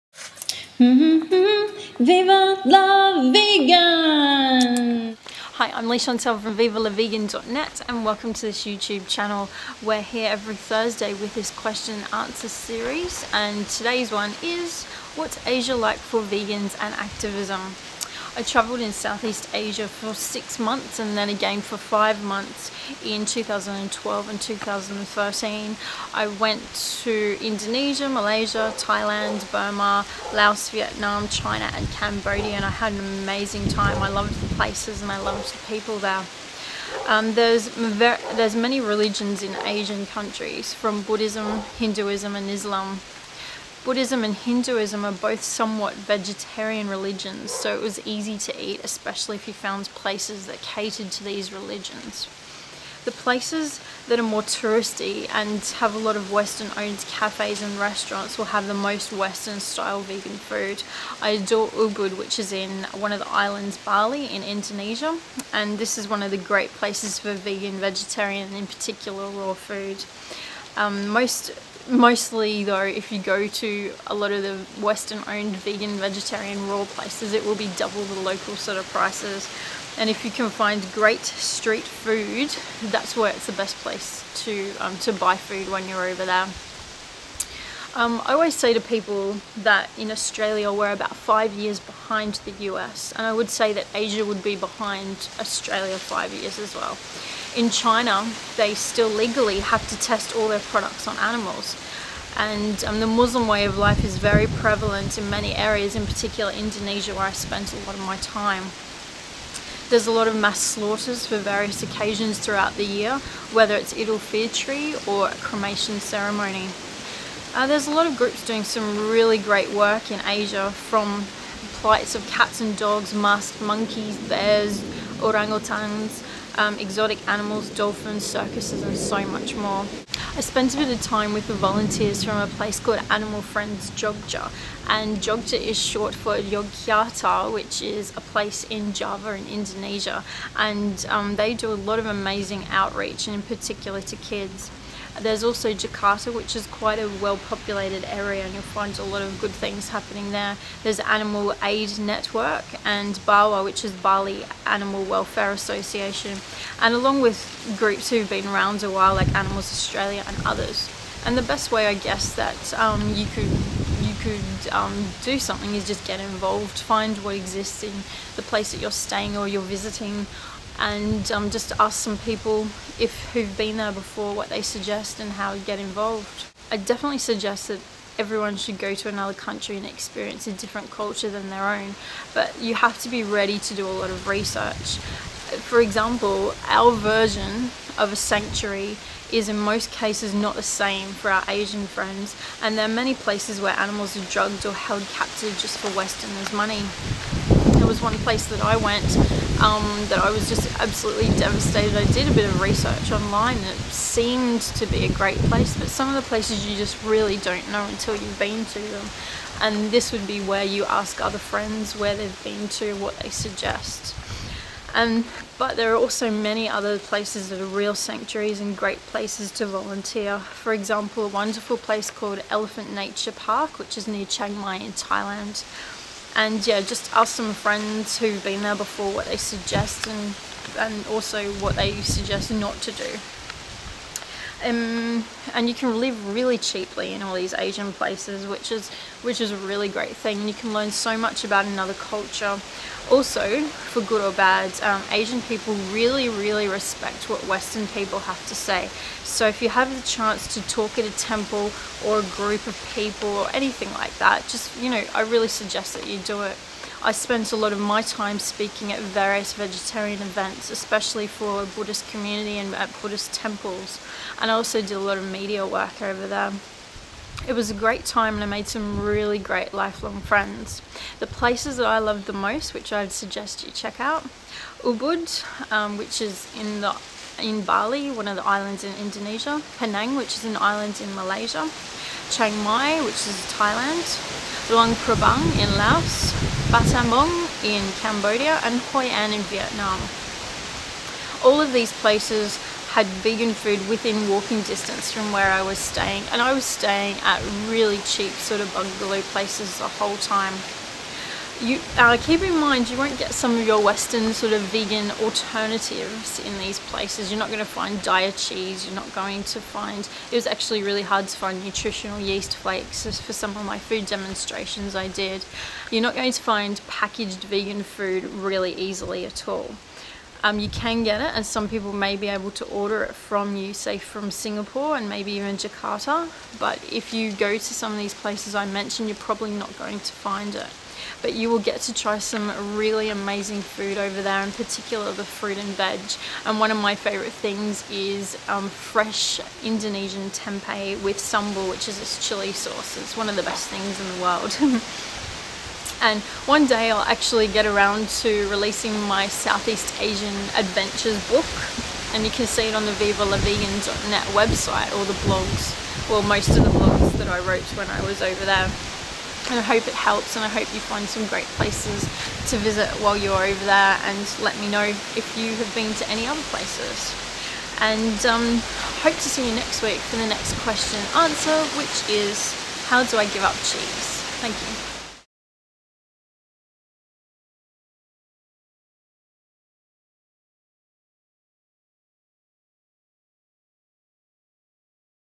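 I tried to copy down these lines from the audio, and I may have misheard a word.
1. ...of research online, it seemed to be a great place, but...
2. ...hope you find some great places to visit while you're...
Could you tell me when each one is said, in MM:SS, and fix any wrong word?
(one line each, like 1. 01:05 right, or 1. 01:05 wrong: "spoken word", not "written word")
1. 03:22 right
2. 06:00 right.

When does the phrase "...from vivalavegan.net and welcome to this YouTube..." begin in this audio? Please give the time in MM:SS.
00:06.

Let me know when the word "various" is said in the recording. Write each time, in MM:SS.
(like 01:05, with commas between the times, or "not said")
01:51, 04:18.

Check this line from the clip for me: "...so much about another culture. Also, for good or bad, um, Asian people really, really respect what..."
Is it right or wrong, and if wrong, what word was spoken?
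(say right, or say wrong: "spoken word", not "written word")
right.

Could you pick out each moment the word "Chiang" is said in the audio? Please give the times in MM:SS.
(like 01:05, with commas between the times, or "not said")
03:44, 04:42.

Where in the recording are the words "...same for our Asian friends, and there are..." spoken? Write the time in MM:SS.
03:10.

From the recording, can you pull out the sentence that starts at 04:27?
It was a great time and I made some really great lifelong friends.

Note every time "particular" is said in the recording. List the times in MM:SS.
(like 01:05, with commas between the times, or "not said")
01:08, 01:46, 02:23, 05:34.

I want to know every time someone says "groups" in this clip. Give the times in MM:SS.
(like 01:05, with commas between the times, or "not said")
01:58, 02:37, 04:12.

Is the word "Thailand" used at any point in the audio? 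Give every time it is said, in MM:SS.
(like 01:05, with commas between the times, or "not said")
00:28, 03:44, 04:43.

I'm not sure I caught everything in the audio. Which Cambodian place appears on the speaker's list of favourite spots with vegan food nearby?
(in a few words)
Battambang.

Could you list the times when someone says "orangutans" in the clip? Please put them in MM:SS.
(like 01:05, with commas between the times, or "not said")
02:05.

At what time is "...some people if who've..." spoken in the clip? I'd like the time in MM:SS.
02:52.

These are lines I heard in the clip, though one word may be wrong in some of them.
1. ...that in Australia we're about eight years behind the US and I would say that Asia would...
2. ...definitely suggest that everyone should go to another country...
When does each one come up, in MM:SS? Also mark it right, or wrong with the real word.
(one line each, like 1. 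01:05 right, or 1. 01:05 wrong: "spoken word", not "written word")
1. 01:29 wrong: "five", not "eight"
2. 02:56 right.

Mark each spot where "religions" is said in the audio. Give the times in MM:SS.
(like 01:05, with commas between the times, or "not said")
00:38, 00:46, 00:51.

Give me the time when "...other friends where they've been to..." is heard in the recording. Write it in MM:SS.
03:31.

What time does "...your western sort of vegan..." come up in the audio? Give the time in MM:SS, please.
05:03.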